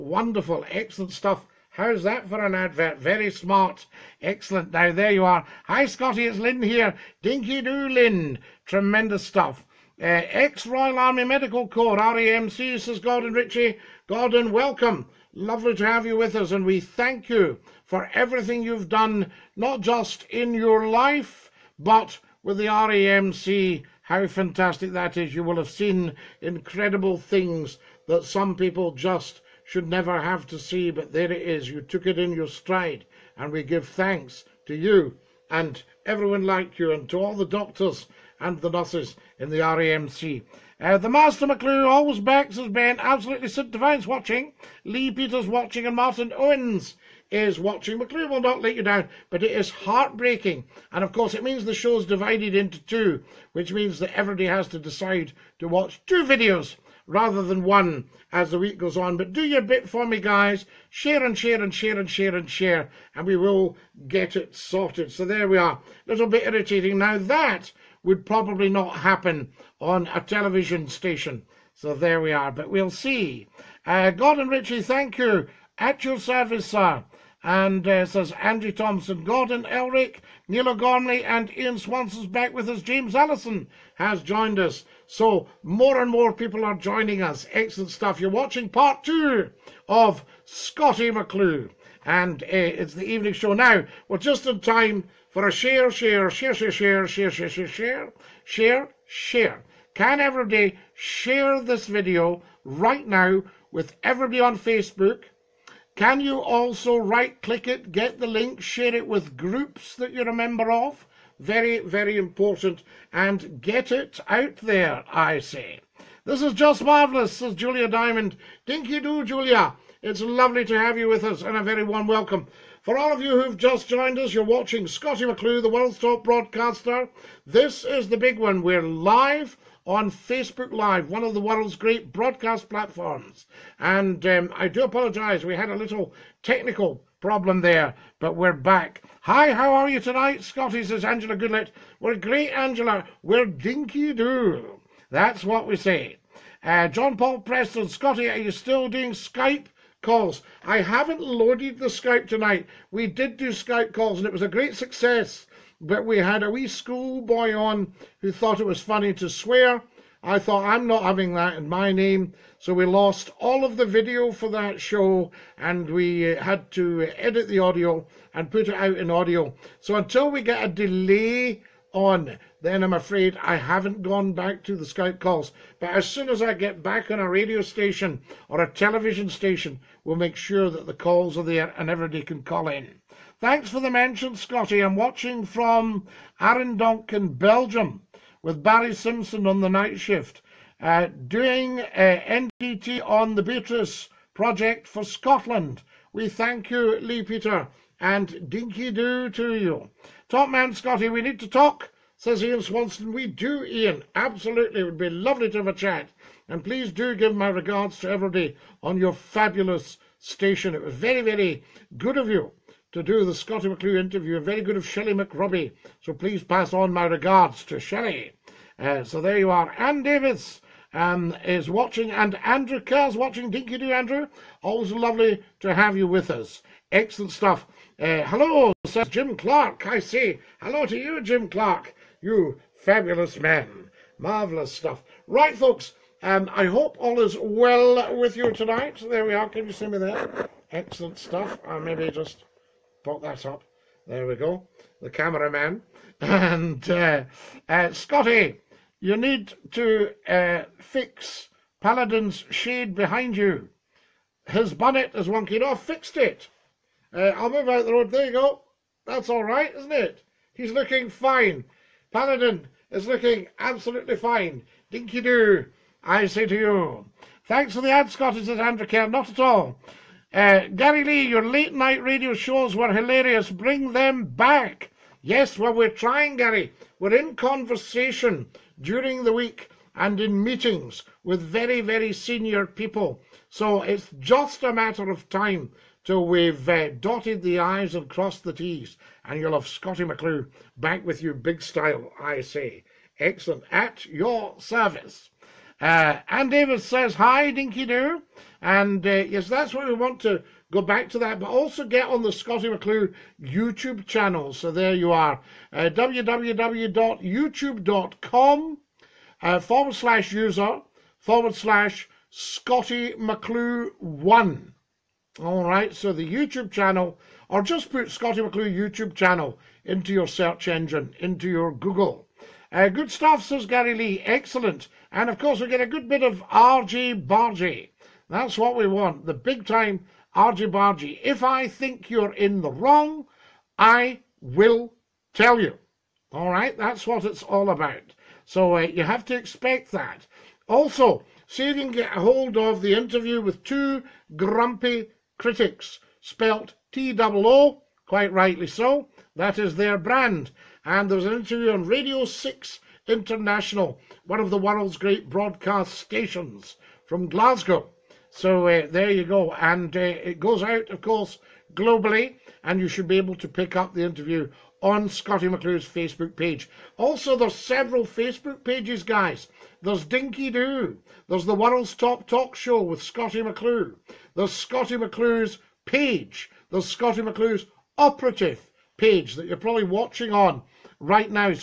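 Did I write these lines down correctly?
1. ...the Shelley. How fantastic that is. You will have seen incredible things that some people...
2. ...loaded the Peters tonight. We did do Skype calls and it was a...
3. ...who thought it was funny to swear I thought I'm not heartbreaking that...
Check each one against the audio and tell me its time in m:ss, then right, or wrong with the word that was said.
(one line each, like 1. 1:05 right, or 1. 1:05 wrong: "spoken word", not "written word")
1. 0:22 wrong: "RAMC", not "Shelley"
2. 2:31 wrong: "Skype", not "Peters"
3. 2:38 wrong: "having", not "heartbreaking".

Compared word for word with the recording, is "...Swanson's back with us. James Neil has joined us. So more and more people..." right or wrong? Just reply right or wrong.
wrong.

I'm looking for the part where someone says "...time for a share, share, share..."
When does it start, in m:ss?
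1:34.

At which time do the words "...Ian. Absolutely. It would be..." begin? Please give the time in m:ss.
3:23.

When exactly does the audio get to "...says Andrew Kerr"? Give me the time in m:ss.
4:28.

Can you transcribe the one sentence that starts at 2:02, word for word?
For all of you who've just joined us, you're watching Scottie McClue, the world's top broadcaster.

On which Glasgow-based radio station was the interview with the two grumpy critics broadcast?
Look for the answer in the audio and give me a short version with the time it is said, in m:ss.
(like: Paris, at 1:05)
Radio 6 International, at 5:51.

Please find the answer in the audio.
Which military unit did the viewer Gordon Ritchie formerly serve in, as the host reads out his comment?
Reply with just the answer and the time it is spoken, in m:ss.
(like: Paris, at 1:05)
Royal Army Medical Corps, at 0:10.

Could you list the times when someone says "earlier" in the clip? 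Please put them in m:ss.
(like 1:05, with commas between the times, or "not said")
not said.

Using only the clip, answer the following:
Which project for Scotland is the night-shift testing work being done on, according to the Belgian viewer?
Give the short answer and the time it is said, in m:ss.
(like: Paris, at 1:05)
Beatrice project, at 3:13.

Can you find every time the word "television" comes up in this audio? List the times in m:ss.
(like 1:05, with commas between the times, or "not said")
1:10, 2:58.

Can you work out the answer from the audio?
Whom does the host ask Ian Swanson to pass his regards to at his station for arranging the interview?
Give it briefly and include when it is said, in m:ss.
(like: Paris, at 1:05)
Shelley McRobbie, at 3:34.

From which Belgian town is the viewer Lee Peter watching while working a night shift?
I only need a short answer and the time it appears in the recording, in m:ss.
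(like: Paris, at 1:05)
Arendonk, at 3:06.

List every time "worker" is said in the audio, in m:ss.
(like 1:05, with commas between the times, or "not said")
not said.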